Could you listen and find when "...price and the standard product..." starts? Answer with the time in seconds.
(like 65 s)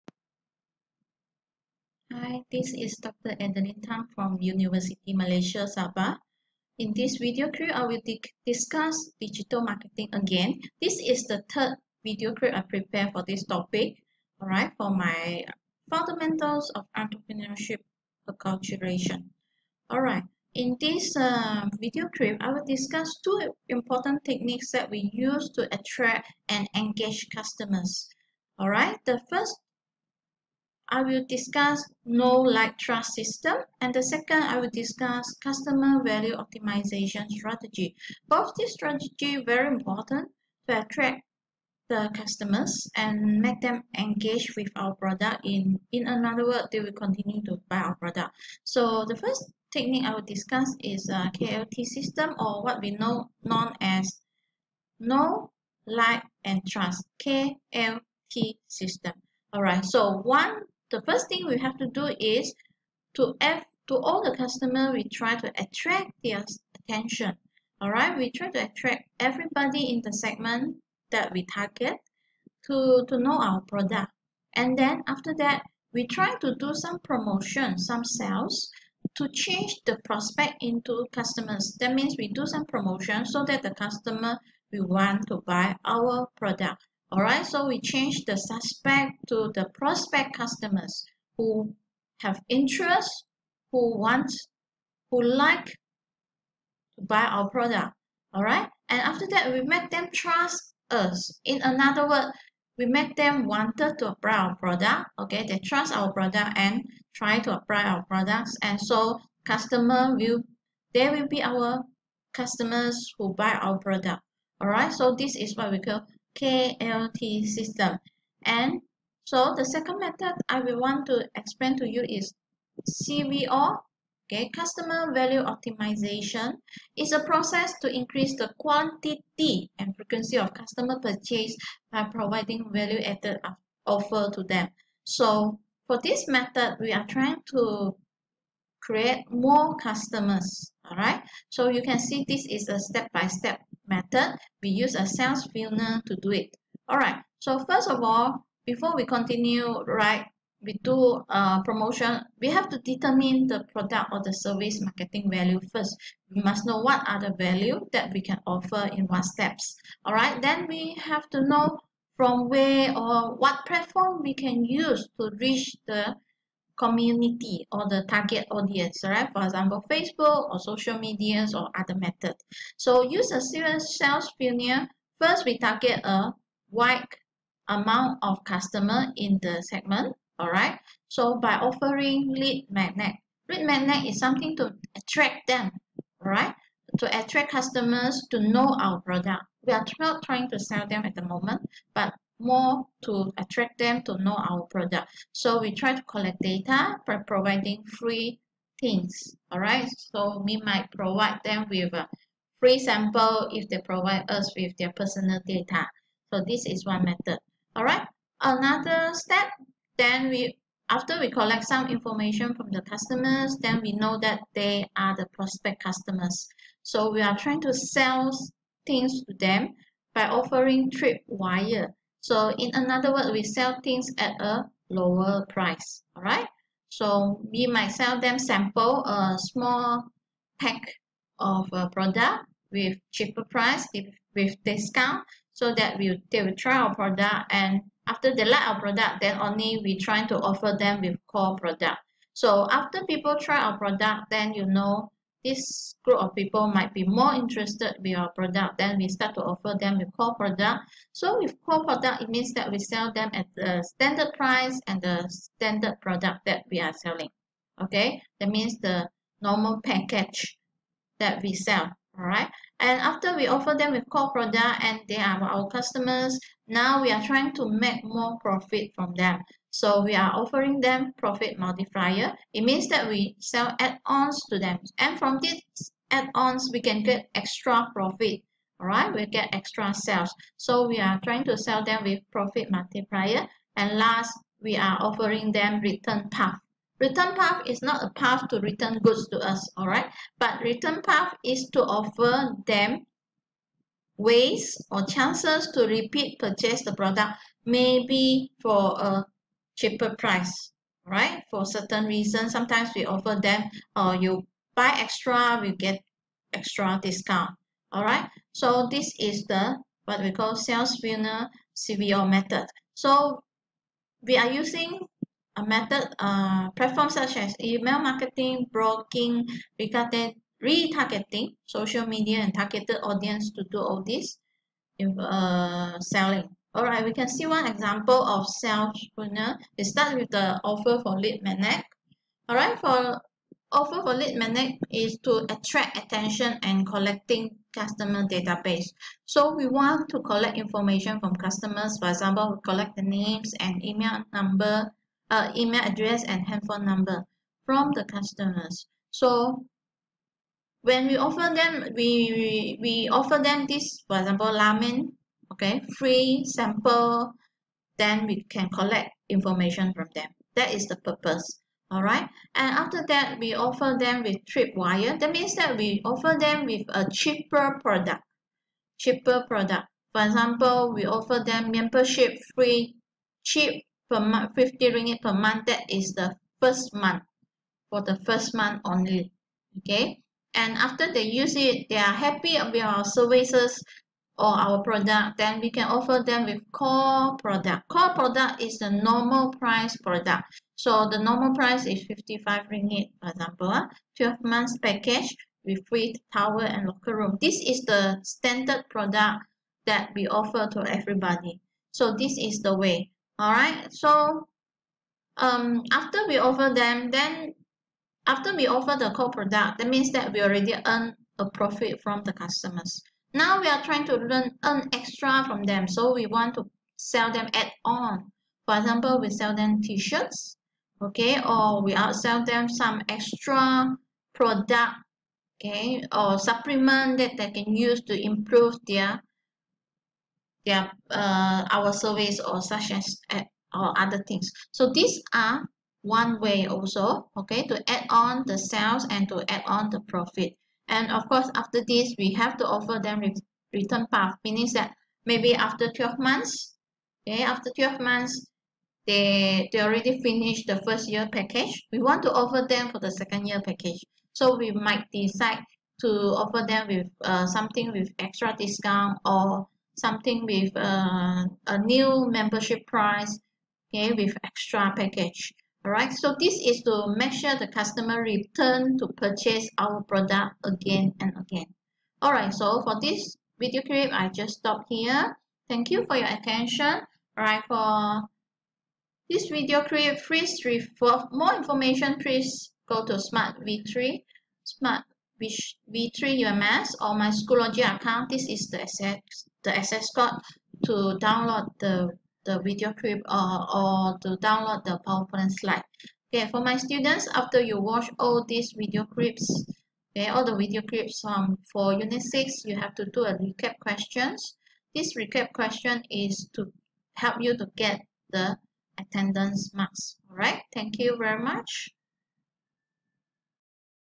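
254 s.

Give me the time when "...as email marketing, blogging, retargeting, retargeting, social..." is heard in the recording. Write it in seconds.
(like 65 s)
317 s.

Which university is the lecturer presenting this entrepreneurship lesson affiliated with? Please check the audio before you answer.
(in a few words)
University Malaysia Sabah.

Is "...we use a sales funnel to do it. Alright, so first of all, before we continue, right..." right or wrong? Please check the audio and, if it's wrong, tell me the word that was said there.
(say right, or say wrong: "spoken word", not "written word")
right.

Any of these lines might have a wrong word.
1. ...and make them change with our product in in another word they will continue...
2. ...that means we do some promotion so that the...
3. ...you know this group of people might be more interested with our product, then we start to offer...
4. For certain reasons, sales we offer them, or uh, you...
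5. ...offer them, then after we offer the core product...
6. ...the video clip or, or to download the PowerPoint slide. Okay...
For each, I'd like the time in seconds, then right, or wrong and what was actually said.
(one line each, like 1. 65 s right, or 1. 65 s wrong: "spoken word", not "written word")
1. 42 s wrong: "engage", not "change"
2. 81 s right
3. 244 s right
4. 301 s wrong: "sometimes", not "sales"
5. 406 s right
6. 492 s right.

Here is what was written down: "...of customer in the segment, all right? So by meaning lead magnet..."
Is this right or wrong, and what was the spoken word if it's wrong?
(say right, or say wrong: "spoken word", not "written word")
wrong: "offering", not "meaning".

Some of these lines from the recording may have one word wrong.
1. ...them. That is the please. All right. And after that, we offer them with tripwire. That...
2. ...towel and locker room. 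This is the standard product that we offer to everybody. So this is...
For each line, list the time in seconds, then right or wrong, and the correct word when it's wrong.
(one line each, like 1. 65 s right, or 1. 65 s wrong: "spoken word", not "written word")
1. 360 s wrong: "purpose", not "please"
2. 396 s right.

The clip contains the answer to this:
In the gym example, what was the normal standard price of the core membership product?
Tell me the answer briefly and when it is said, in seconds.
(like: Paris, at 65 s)
55 ringgit, at 392 s.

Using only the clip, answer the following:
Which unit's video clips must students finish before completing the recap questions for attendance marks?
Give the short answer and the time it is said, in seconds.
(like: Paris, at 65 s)
Unit 6, at 501 s.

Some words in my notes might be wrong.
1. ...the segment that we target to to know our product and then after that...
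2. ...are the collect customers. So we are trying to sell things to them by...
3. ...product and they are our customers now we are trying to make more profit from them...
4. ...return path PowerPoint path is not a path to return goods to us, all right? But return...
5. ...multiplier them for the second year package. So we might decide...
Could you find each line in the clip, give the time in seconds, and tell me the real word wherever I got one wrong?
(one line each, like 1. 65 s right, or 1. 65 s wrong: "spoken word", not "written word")
1. 70 s right
2. 214 s wrong: "prospect", not "collect"
3. 264 s right
4. 285 s wrong: "Return", not "PowerPoint"
5. 452 s wrong: "offer", not "multiplier".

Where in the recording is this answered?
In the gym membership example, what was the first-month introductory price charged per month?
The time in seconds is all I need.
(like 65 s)
374 s.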